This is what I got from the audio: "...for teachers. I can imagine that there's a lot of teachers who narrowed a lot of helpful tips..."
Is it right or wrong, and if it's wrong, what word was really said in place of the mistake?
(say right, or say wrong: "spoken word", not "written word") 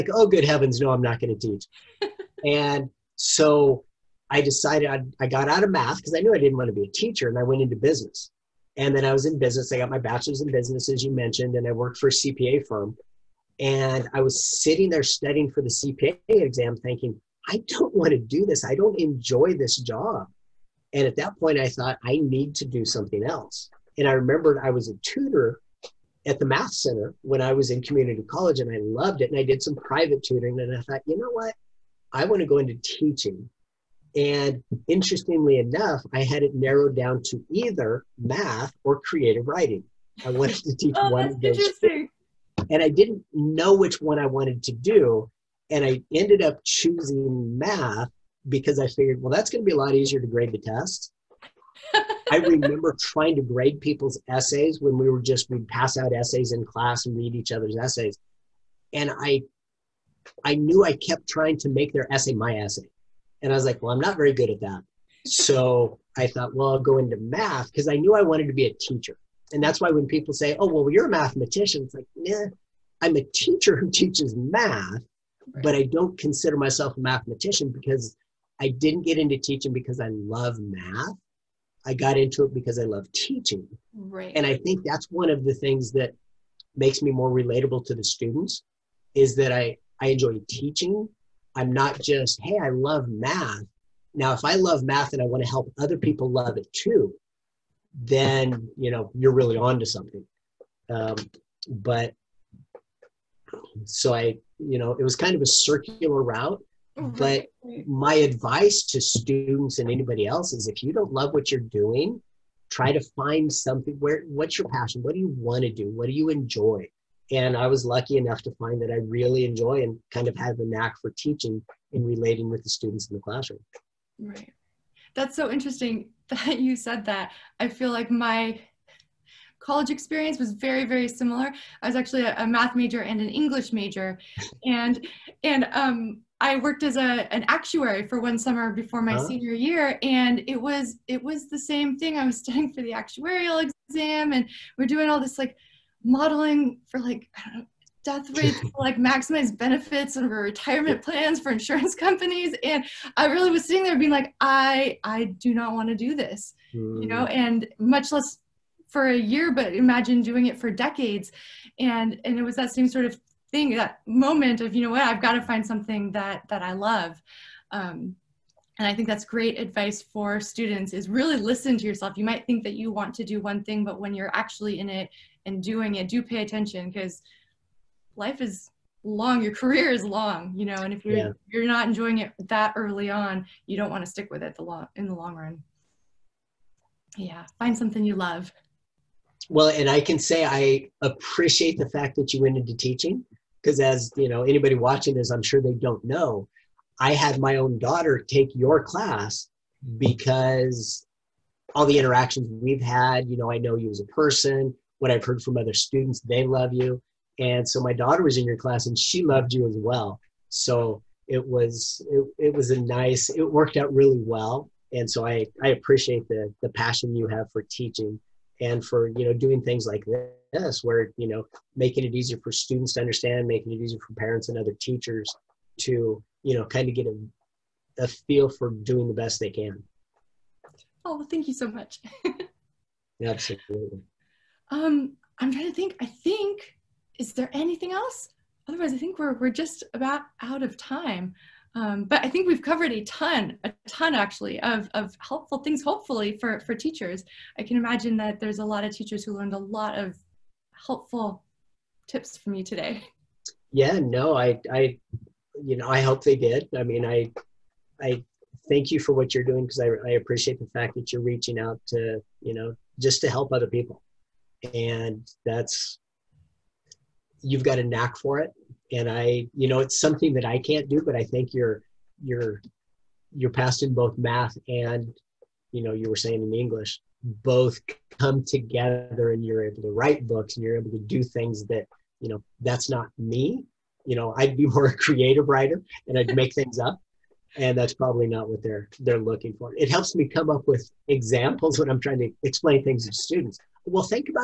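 wrong: "learned", not "narrowed".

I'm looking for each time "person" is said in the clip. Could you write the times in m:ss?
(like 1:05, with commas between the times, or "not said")
3:24.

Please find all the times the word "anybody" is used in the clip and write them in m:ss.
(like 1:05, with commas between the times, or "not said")
1:49, 3:14.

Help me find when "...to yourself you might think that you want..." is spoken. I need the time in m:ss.
2:51.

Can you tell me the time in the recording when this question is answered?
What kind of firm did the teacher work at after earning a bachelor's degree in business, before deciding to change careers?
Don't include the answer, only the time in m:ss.
0:12.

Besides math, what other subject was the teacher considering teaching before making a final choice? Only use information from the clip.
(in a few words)
Creative writing.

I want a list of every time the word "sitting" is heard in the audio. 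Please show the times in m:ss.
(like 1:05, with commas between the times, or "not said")
0:14, 2:33.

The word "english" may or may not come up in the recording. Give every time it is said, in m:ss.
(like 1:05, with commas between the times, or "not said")
2:13, 4:36.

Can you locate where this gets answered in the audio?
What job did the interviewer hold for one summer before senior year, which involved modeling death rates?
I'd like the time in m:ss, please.
2:17.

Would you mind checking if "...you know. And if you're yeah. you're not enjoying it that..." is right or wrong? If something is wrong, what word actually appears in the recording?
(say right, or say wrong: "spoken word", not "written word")
right.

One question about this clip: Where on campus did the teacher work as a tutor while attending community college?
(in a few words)
Math center.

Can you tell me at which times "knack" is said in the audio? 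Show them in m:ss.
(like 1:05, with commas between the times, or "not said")
2:00, 4:27.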